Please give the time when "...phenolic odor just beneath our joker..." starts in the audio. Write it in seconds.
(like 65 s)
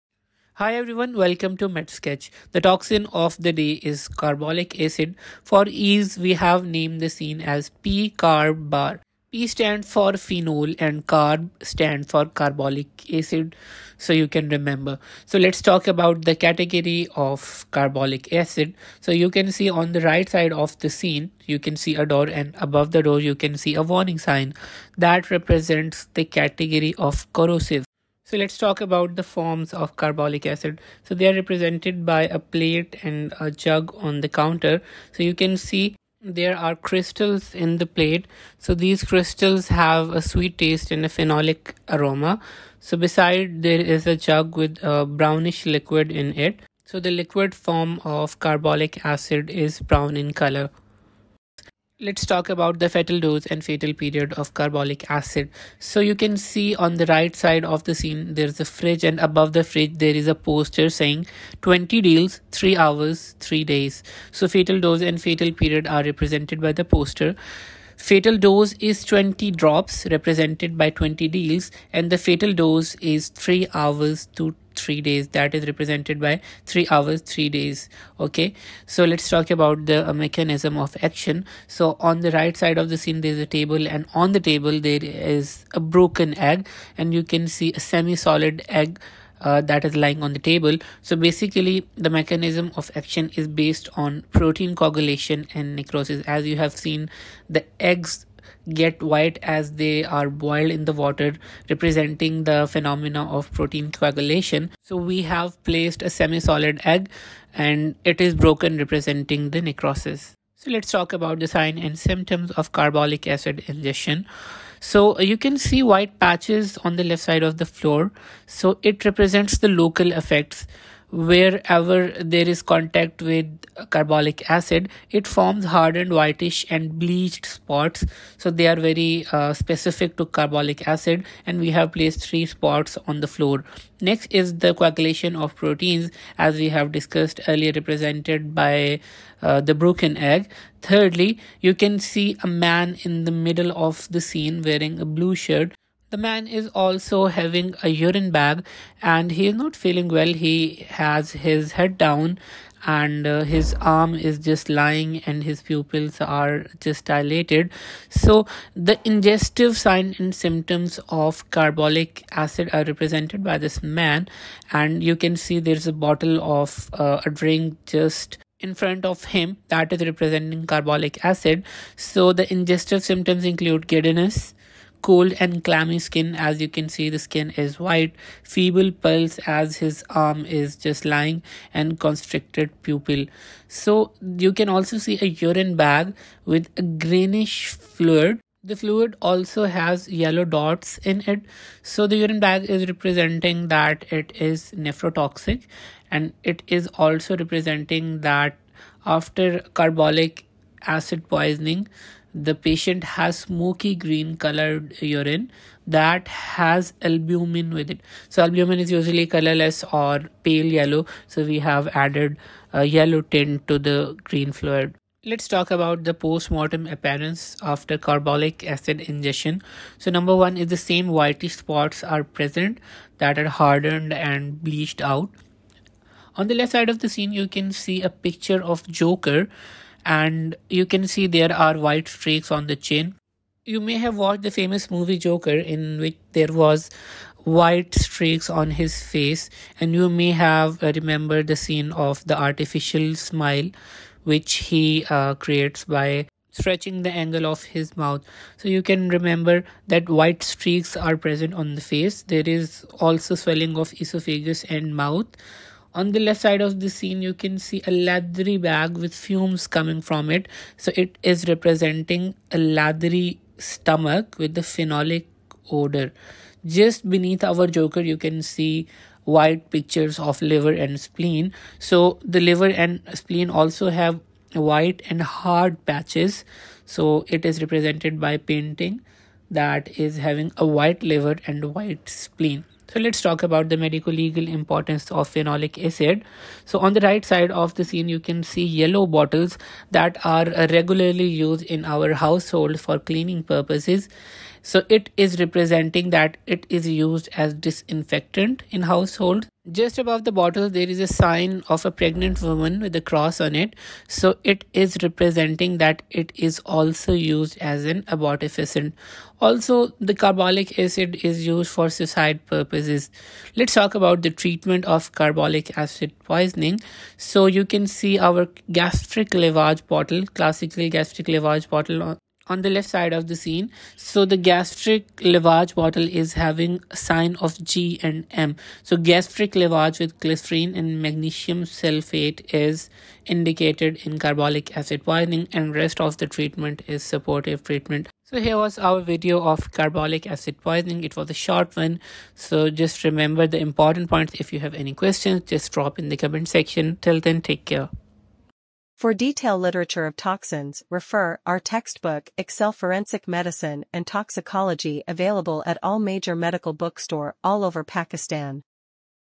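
264 s.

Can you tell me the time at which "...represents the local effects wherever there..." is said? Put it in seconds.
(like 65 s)
119 s.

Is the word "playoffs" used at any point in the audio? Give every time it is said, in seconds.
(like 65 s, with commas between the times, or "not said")
not said.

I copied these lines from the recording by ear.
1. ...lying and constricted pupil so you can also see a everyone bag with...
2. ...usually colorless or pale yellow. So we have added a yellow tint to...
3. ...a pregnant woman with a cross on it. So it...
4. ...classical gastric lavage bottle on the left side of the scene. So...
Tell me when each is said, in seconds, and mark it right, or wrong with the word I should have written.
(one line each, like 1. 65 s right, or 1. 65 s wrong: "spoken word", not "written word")
1. 181 s wrong: "urine", not "everyone"
2. 208 s right
3. 301 s right
4. 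320 s right.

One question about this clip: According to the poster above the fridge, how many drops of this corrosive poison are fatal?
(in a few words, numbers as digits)
20.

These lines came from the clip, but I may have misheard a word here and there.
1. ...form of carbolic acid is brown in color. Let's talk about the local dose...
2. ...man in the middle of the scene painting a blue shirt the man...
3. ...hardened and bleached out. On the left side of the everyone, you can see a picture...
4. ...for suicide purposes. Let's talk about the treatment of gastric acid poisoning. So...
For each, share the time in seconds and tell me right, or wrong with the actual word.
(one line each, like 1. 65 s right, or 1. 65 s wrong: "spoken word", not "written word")
1. 47 s wrong: "fetal", not "local"
2. 142 s wrong: "wearing", not "painting"
3. 223 s wrong: "scene", not "everyone"
4. 311 s wrong: "carbolic", not "gastric".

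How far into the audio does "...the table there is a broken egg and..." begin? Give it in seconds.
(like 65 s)
84 s.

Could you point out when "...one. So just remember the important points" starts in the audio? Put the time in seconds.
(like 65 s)
341 s.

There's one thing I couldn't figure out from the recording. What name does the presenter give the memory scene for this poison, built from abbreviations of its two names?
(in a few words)
P-carb bar.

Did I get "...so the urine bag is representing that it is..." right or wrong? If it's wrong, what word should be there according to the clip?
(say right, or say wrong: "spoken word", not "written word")
right.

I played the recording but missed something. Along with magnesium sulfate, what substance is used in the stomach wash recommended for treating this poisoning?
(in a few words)
Glycerine.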